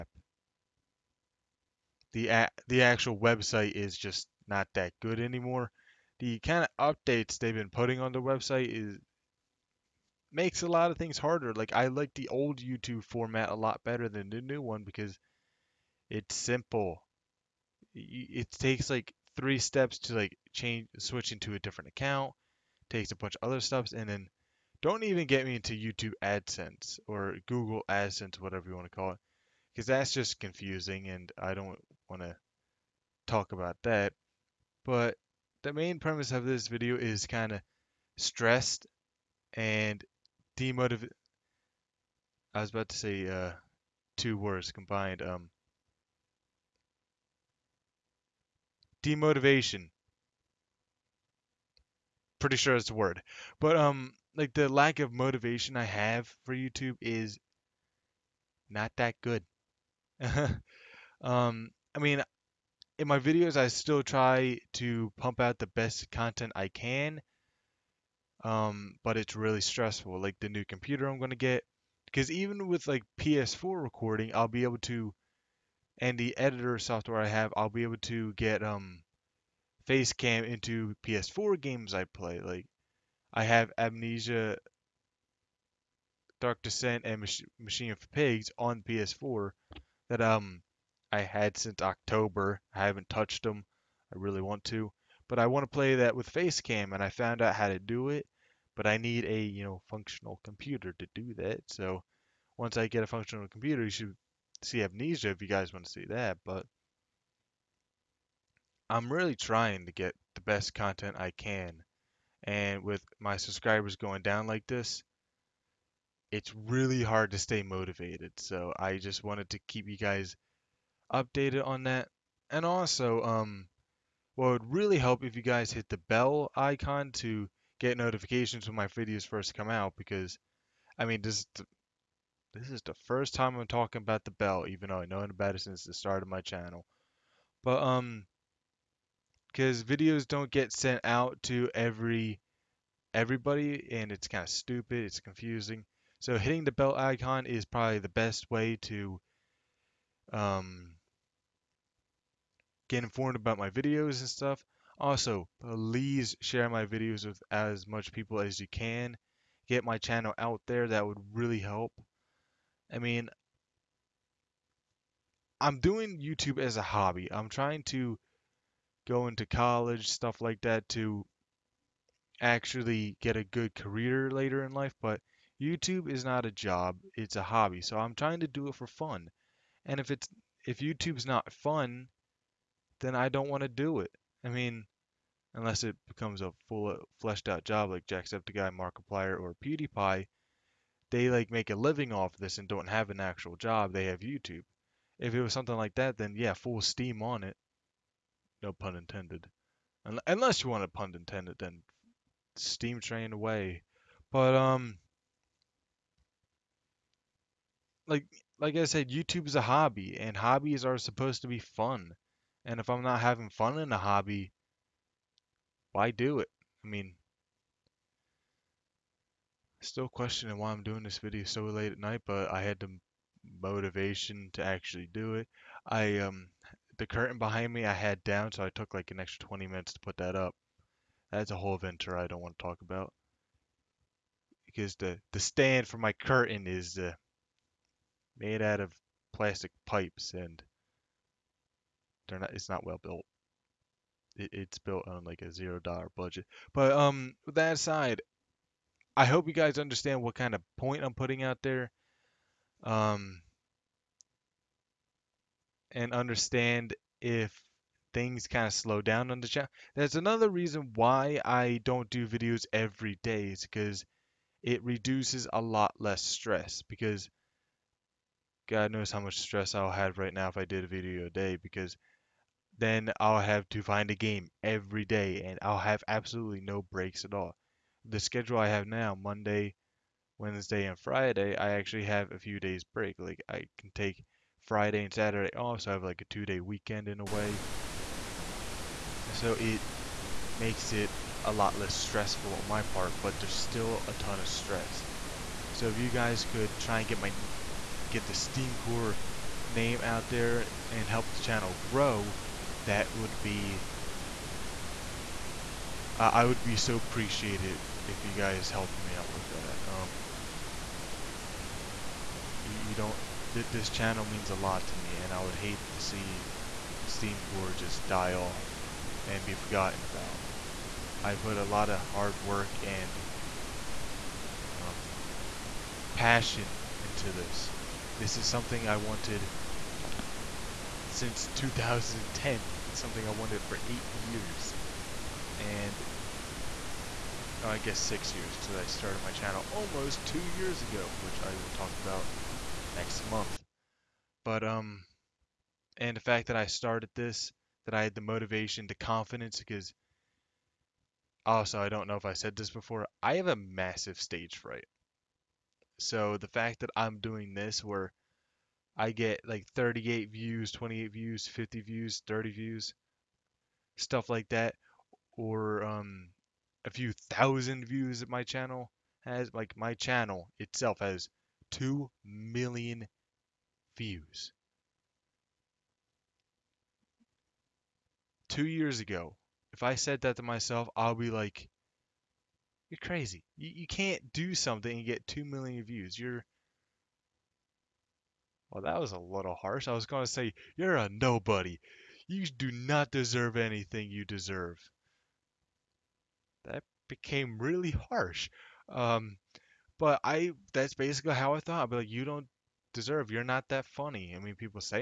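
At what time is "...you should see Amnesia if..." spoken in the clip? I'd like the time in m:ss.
1:43.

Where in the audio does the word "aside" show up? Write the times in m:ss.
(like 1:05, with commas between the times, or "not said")
4:07.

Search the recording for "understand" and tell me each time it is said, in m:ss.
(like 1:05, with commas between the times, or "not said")
4:09, 4:16.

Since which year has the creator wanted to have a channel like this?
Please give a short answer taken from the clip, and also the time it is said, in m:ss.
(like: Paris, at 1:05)
2010, at 5:31.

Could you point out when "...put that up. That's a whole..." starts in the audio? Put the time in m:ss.
3:50.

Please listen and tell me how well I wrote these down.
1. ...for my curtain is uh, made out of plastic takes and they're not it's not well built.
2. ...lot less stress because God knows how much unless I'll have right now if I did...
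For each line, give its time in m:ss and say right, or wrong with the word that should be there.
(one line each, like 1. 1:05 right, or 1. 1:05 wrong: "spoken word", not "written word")
1. 3:55 wrong: "pipes", not "takes"
2. 4:25 wrong: "stress", not "unless".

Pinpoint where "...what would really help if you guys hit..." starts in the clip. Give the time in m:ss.
2:04.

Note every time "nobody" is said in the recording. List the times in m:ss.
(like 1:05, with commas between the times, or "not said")
6:31.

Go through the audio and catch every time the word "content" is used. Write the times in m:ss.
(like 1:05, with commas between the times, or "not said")
1:06, 1:50.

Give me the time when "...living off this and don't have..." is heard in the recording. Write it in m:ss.
3:11.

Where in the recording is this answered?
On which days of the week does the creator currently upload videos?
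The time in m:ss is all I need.
4:39.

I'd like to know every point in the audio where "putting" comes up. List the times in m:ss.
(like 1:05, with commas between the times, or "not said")
0:07, 4:11.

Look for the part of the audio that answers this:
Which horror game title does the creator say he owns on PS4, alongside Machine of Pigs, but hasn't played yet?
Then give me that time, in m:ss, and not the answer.
1:23.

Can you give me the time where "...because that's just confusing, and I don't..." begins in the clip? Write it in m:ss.
0:29.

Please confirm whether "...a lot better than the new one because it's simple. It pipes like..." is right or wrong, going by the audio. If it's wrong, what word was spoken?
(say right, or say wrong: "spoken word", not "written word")
wrong: "takes", not "pipes".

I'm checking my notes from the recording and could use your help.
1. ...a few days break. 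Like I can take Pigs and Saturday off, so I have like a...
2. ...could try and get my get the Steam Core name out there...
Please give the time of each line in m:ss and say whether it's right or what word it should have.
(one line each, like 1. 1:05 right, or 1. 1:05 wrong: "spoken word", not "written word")
1. 4:42 wrong: "Friday", not "Pigs"
2. 4:56 right.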